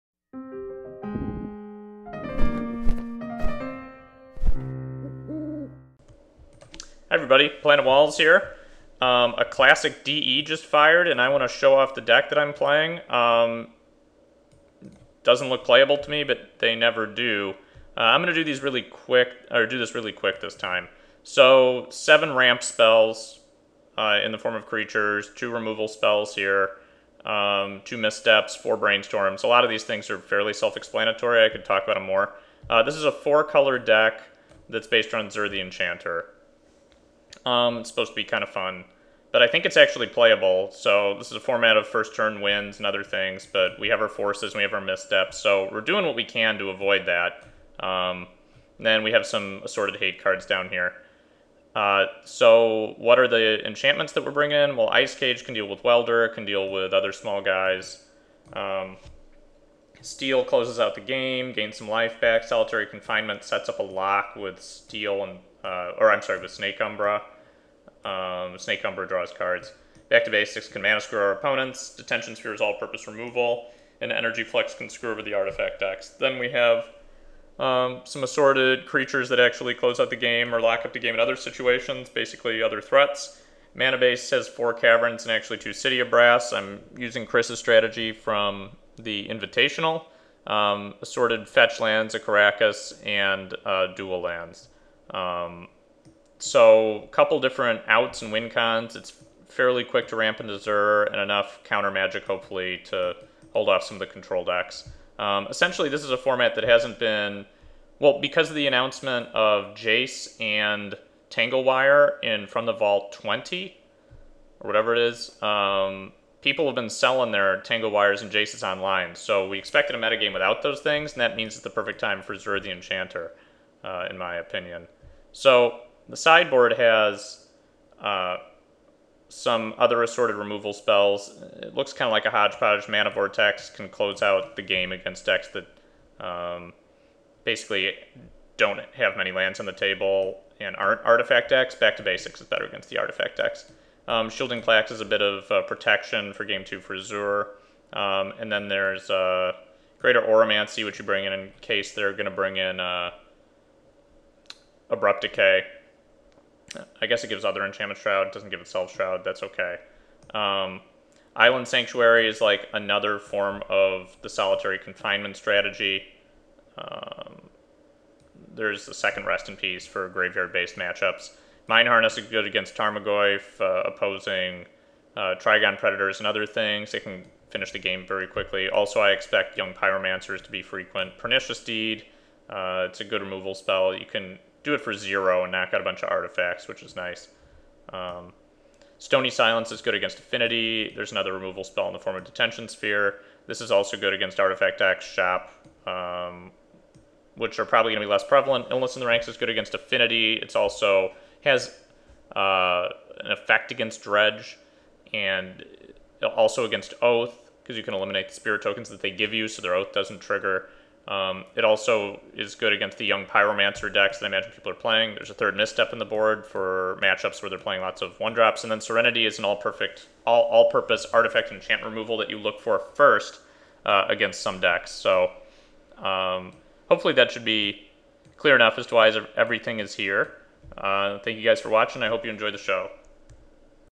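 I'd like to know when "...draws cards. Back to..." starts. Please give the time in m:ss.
1:09.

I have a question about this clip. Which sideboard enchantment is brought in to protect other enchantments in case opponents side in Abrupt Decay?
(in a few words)
Greater Auramancy.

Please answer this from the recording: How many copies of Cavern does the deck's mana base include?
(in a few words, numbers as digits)
4.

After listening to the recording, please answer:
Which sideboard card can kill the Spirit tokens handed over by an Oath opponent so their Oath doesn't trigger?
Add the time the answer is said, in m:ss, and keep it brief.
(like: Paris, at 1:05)
Illness in the Ranks, at 3:18.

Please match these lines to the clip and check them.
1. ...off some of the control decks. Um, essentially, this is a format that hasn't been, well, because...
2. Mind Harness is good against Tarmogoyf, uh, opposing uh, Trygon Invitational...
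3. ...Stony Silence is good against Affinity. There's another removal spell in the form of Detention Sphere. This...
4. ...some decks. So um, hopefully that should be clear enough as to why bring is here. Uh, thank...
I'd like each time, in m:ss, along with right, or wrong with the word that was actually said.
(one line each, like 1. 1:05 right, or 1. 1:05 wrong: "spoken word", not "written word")
1. 1:43 right
2. 2:51 wrong: "Predators", not "Invitational"
3. 3:08 right
4. 3:44 wrong: "everything", not "bring".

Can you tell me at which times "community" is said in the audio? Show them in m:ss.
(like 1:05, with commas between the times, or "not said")
not said.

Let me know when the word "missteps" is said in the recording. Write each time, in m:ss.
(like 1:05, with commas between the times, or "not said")
0:27, 0:44, 3:35.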